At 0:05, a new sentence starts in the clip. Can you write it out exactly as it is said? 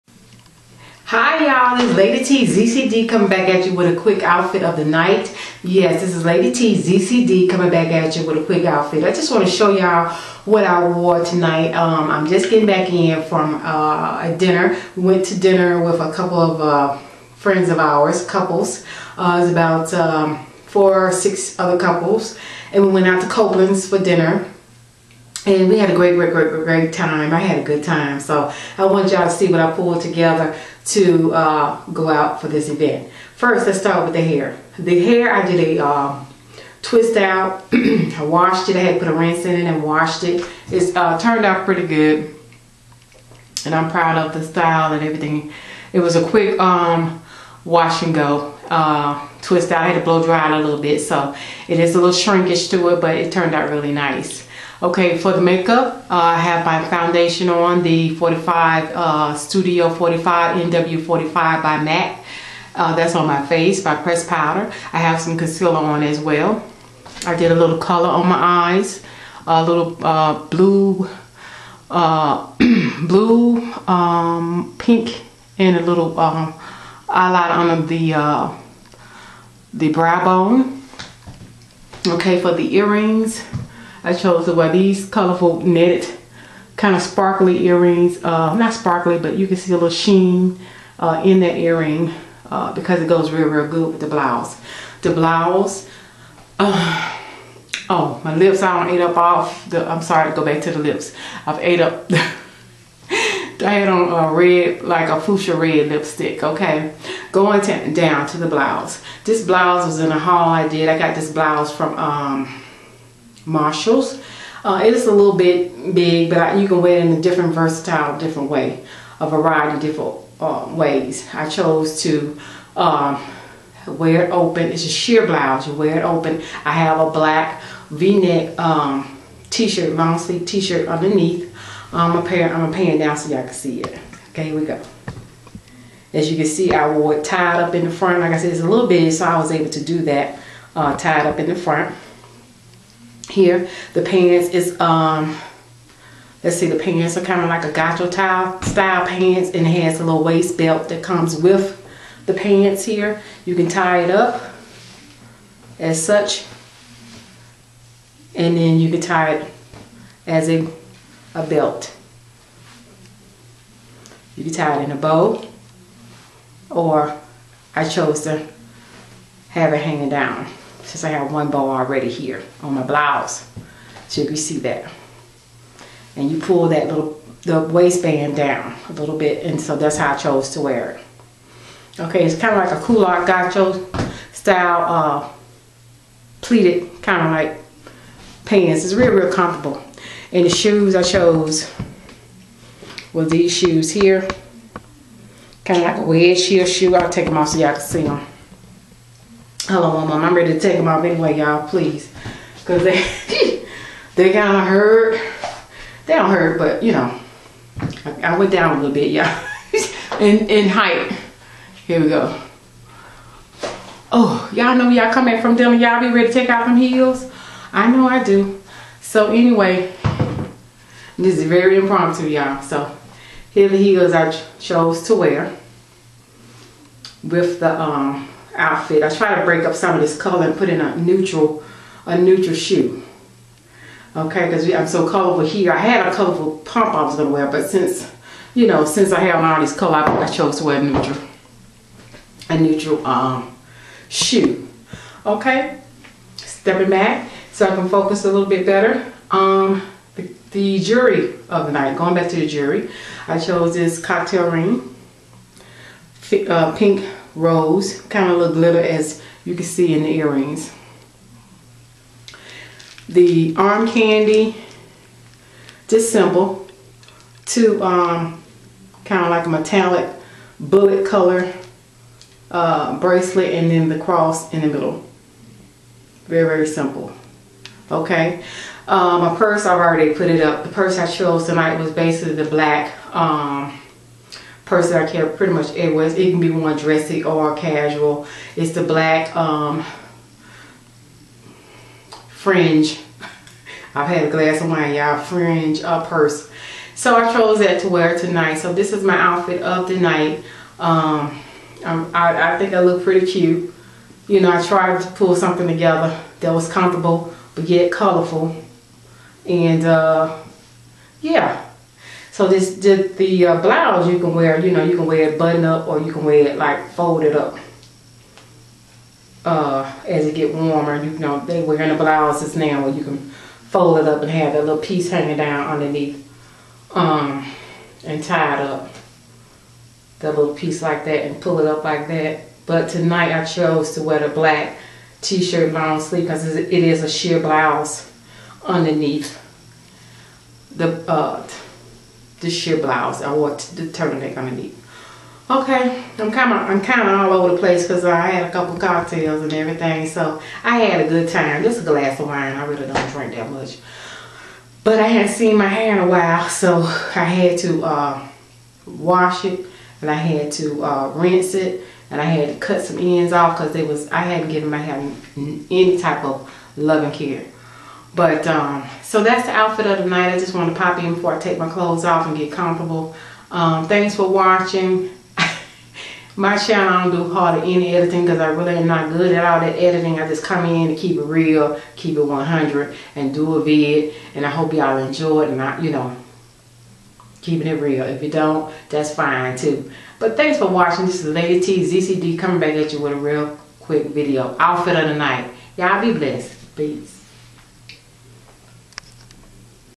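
Yes, this is Lady T ZCD coming back at you with a quick outfit.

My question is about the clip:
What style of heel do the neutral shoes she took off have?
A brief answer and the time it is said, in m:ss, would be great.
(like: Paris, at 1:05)
wedge heel, at 3:16.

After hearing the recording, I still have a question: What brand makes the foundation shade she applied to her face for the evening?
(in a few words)
MAC.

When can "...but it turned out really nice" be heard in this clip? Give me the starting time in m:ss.
0:53.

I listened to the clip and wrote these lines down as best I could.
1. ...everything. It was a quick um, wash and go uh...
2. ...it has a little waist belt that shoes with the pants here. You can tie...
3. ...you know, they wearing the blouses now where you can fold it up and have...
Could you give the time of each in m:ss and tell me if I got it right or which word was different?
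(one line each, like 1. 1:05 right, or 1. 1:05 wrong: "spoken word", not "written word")
1. 0:45 right
2. 2:29 wrong: "comes", not "shoes"
3. 5:21 right.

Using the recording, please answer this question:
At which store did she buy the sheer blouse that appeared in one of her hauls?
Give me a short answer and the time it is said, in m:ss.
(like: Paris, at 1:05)
Marshalls, at 1:53.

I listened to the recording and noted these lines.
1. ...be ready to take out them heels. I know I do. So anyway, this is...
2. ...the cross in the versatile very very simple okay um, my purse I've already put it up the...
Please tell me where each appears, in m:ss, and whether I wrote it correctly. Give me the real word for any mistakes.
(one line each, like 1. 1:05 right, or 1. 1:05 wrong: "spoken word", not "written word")
1. 3:36 right
2. 4:33 wrong: "middle", not "versatile".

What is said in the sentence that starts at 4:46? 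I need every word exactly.
It can be one dressy or casual.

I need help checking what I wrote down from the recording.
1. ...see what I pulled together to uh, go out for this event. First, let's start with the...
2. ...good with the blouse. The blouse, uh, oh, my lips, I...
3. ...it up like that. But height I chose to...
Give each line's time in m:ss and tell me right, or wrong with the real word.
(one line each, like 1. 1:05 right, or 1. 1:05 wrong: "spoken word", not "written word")
1. 0:29 right
2. 1:33 right
3. 5:31 wrong: "tonight", not "height".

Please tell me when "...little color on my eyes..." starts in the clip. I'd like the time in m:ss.
1:07.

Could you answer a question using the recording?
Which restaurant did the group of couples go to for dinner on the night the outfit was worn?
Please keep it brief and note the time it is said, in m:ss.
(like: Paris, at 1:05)
Copeland's, at 0:23.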